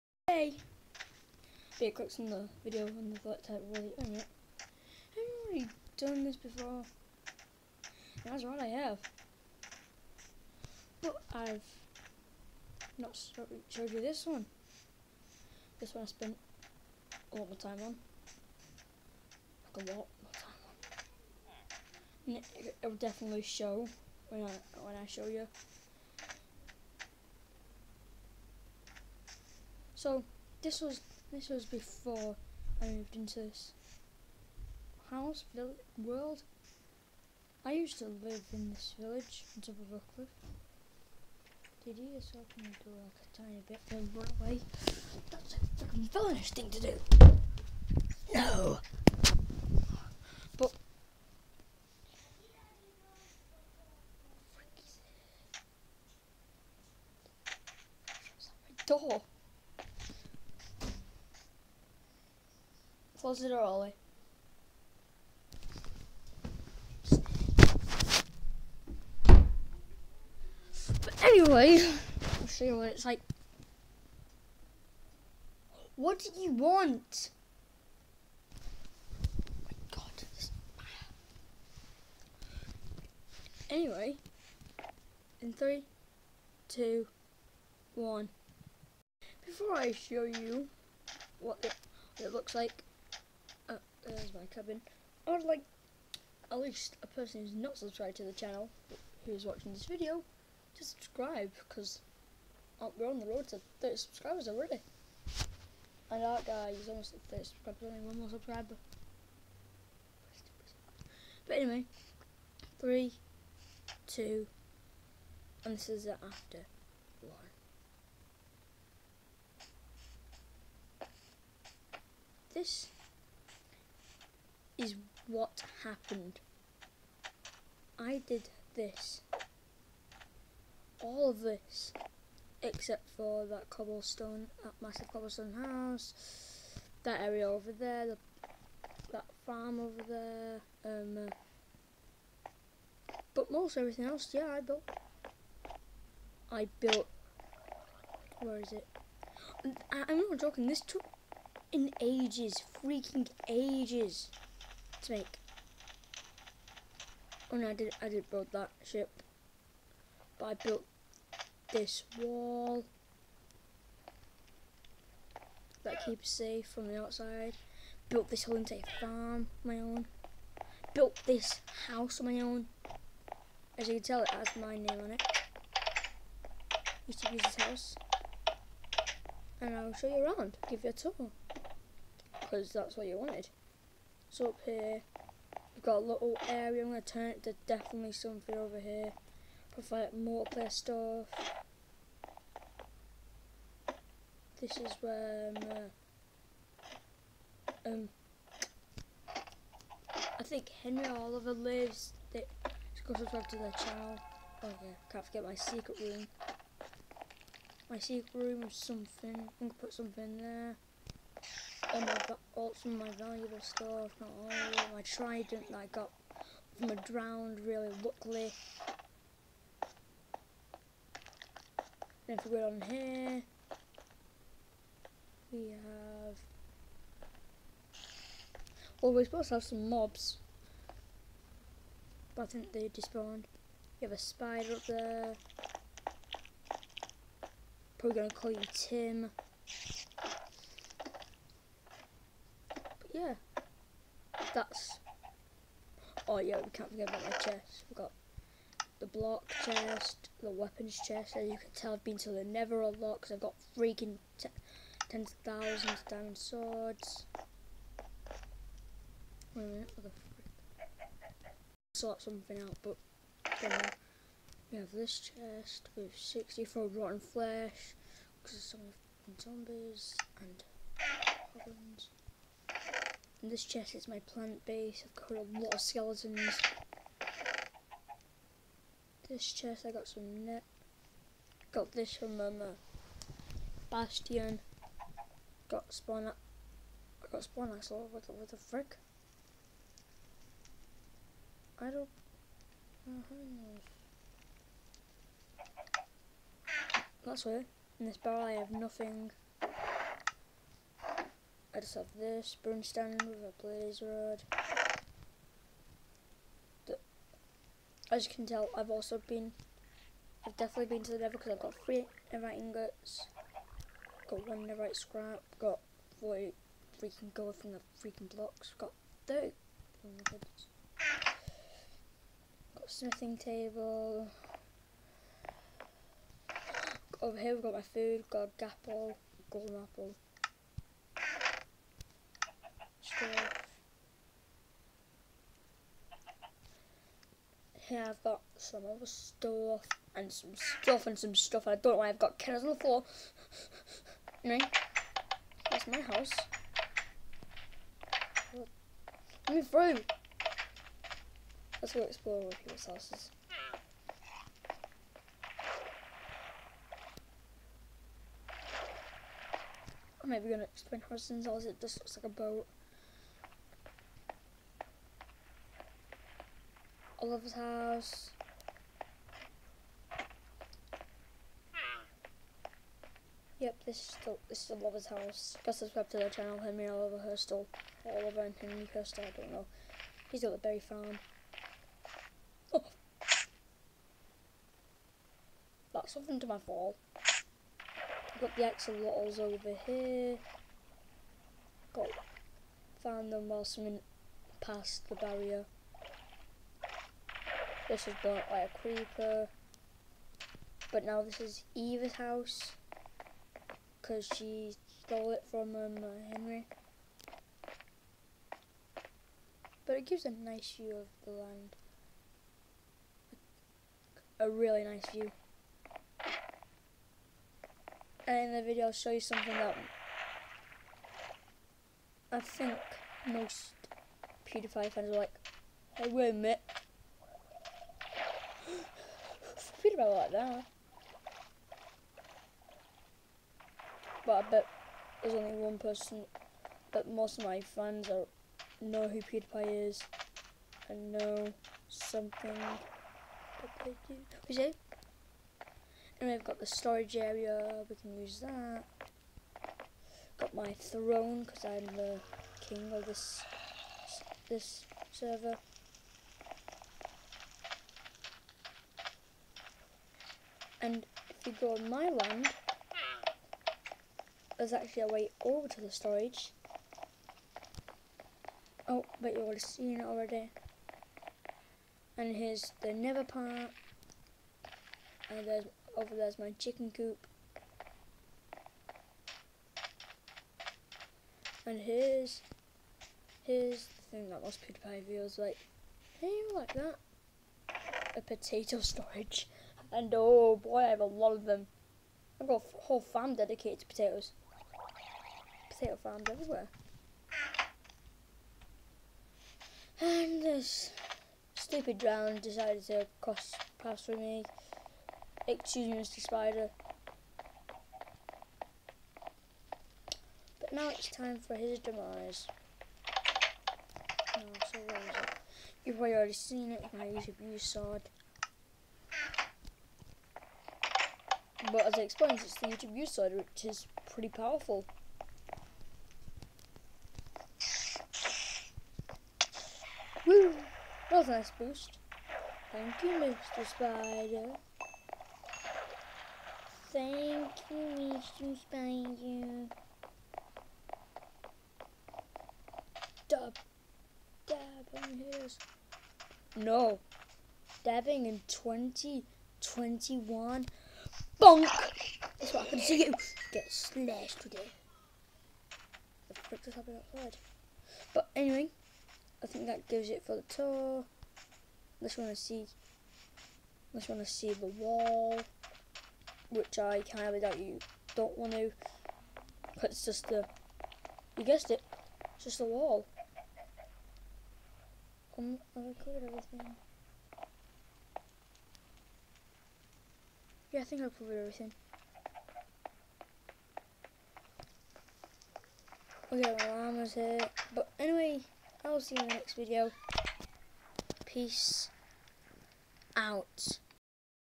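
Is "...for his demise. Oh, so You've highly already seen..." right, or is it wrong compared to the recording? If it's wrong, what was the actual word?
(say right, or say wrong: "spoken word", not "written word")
wrong: "probably", not "highly".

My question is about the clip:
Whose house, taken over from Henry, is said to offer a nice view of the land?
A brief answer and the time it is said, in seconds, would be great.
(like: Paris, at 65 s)
Eva, at 401 s.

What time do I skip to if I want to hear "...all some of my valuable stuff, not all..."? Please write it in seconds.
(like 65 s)
212 s.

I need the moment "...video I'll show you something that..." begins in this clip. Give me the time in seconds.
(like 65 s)
418 s.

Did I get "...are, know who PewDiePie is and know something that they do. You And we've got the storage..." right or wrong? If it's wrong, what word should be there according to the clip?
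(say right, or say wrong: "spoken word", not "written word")
right.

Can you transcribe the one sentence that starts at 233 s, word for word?
You have a spider up there, probably going to call you Tim.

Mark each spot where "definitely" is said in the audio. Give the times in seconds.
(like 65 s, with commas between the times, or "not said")
22 s, 187 s, 310 s.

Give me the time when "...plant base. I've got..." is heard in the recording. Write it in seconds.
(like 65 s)
274 s.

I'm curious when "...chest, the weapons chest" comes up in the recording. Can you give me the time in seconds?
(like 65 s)
249 s.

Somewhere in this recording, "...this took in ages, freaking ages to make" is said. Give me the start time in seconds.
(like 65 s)
150 s.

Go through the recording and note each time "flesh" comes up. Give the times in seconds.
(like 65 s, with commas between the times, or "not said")
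267 s.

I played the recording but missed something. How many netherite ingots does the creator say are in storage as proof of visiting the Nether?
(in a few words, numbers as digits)
3.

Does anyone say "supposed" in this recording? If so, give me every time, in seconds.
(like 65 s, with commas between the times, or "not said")
229 s.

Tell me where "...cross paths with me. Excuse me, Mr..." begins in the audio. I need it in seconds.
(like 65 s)
503 s.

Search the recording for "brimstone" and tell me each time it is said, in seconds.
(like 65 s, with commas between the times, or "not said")
302 s.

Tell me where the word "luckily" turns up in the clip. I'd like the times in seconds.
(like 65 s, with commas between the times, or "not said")
218 s.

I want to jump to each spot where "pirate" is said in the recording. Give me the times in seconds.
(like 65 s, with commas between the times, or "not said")
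not said.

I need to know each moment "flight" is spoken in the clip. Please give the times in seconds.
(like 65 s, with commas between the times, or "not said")
3 s.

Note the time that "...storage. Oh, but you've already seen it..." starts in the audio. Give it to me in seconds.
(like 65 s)
465 s.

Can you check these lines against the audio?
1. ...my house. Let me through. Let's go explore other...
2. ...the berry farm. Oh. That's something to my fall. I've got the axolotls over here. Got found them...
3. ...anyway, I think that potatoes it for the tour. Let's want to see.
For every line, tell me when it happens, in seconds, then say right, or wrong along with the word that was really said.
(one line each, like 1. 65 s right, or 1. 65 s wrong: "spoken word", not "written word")
1. 345 s right
2. 380 s right
3. 558 s wrong: "gives", not "potatoes".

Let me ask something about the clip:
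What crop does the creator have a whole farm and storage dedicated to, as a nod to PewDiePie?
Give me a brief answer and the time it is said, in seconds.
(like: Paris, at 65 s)
Potatoes, at 493 s.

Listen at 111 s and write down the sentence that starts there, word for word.
But anyway, three, two, and this is after one.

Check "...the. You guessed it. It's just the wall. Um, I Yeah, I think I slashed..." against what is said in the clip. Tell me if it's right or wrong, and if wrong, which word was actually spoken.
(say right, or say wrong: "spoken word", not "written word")
wrong: "covered", not "slashed".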